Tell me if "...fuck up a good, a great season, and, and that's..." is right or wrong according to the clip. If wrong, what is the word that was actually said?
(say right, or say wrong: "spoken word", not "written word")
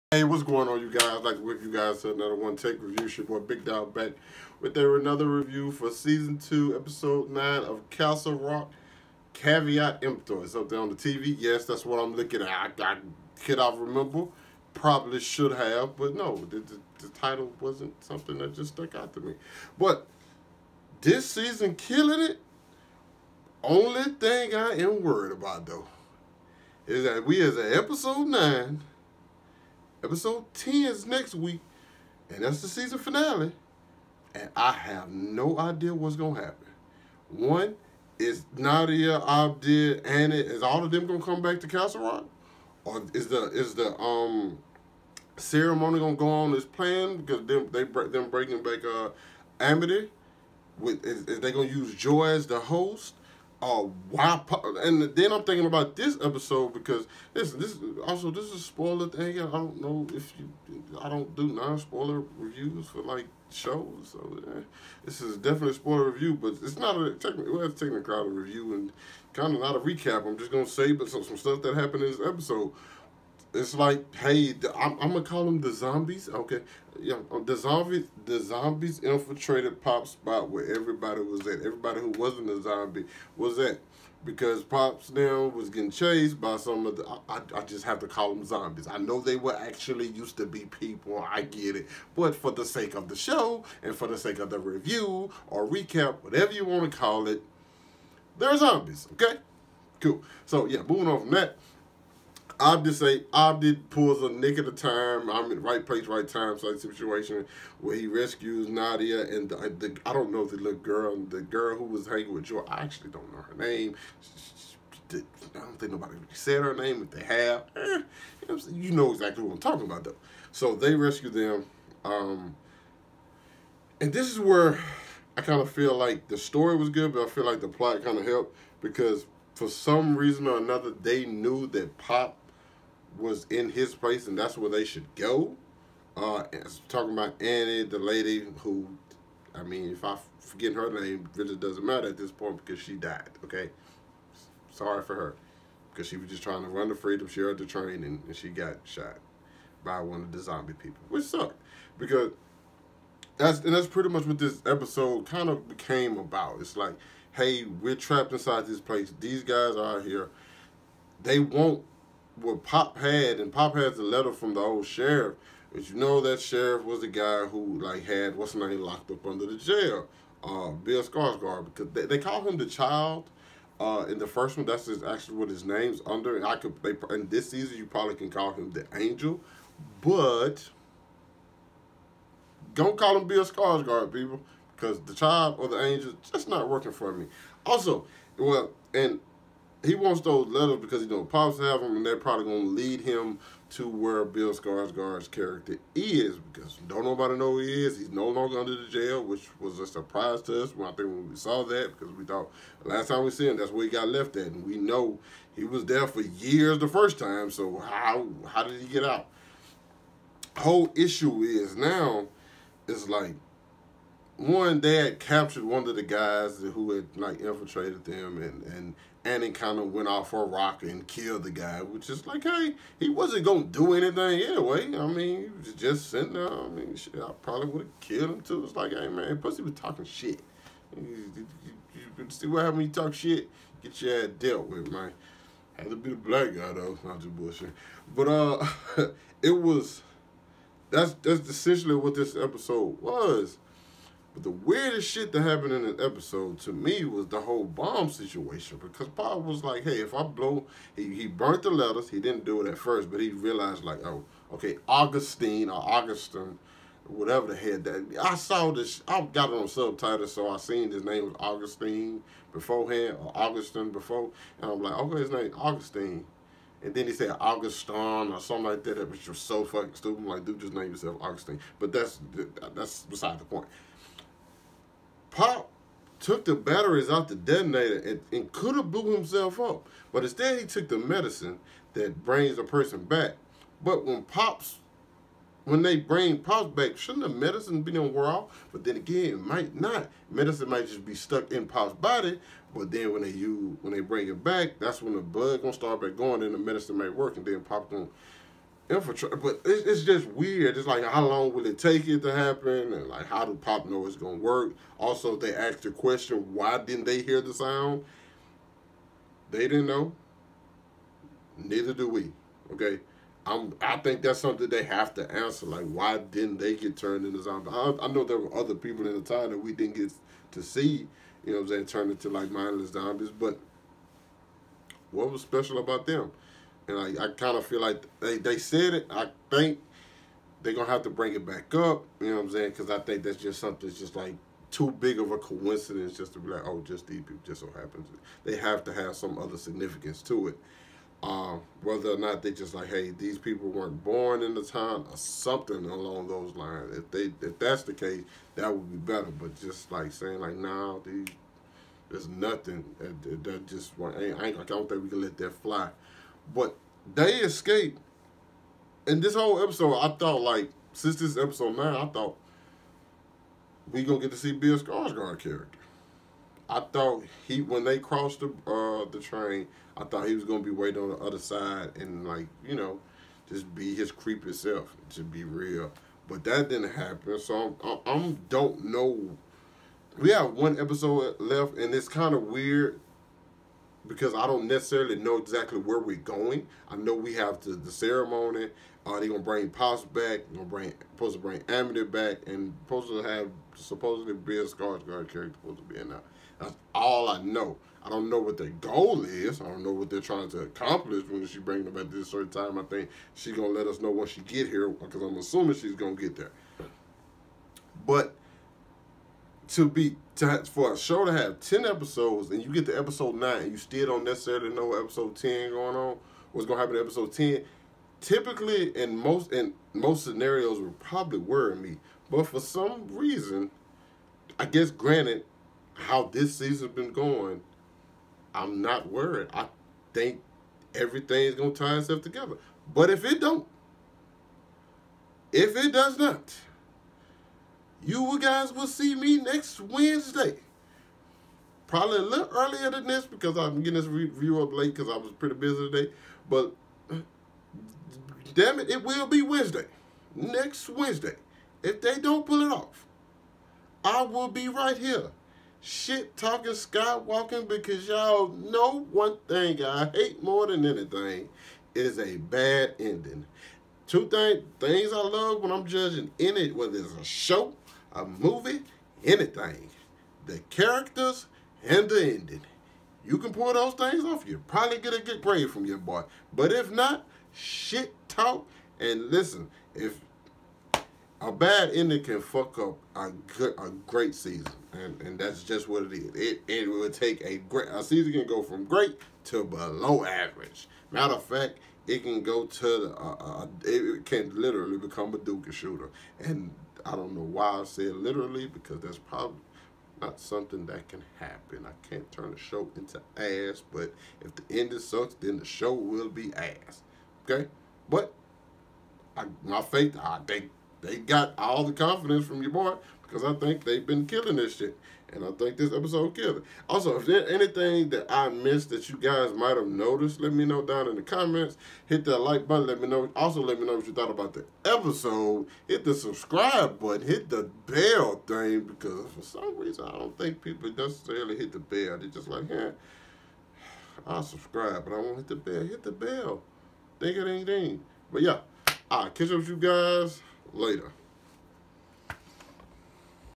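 right.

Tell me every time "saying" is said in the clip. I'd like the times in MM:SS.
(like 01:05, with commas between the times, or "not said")
05:21, 05:32, 05:50.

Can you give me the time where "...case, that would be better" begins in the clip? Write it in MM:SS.
05:47.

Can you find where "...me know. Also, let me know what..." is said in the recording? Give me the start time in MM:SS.
08:43.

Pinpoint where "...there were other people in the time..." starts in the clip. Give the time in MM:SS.
05:18.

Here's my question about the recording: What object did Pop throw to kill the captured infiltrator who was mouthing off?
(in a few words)
a rock.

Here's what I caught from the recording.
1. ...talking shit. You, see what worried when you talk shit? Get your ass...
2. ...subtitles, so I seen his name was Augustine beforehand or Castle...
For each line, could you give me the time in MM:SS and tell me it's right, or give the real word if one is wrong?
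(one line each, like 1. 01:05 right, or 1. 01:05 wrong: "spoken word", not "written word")
1. 03:49 wrong: "happened", not "worried"
2. 04:19 wrong: "Augustine", not "Castle".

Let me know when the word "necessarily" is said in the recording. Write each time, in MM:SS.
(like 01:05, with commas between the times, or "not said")
06:24, 06:54, 08:50.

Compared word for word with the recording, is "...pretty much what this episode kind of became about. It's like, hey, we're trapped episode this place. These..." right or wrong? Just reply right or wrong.
wrong.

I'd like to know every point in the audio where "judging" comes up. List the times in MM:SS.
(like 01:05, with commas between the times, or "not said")
07:45.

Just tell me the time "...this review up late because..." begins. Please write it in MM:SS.
07:23.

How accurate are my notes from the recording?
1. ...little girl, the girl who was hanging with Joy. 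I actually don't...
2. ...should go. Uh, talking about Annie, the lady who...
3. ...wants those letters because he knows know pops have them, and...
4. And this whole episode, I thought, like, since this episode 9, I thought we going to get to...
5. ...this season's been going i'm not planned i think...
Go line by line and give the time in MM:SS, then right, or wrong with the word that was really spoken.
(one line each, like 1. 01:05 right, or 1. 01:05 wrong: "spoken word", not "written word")
1. 01:50 right
2. 02:14 right
3. 03:09 right
4. 05:59 right
5. 07:06 wrong: "worried", not "planned".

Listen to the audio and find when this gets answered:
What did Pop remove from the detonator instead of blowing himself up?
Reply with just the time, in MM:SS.
04:36.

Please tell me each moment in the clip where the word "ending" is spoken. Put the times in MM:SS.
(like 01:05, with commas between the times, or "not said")
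07:42, 07:52, 08:01, 08:24.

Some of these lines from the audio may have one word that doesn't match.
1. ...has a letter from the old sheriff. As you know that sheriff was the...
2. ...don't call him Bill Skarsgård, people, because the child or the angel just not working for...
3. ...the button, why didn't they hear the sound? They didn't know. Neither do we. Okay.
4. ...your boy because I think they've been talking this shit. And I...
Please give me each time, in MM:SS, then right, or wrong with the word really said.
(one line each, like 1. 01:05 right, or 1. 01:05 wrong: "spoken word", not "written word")
1. 02:43 right
2. 03:02 right
3. 05:05 wrong: "question", not "button"
4. 08:32 wrong: "killing", not "talking".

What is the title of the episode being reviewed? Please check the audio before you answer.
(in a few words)
Caveat emptor.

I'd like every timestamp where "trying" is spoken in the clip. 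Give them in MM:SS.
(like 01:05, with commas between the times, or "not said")
02:26, 06:40.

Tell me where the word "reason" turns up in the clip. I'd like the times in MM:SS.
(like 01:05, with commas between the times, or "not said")
02:10, 07:03, 08:49.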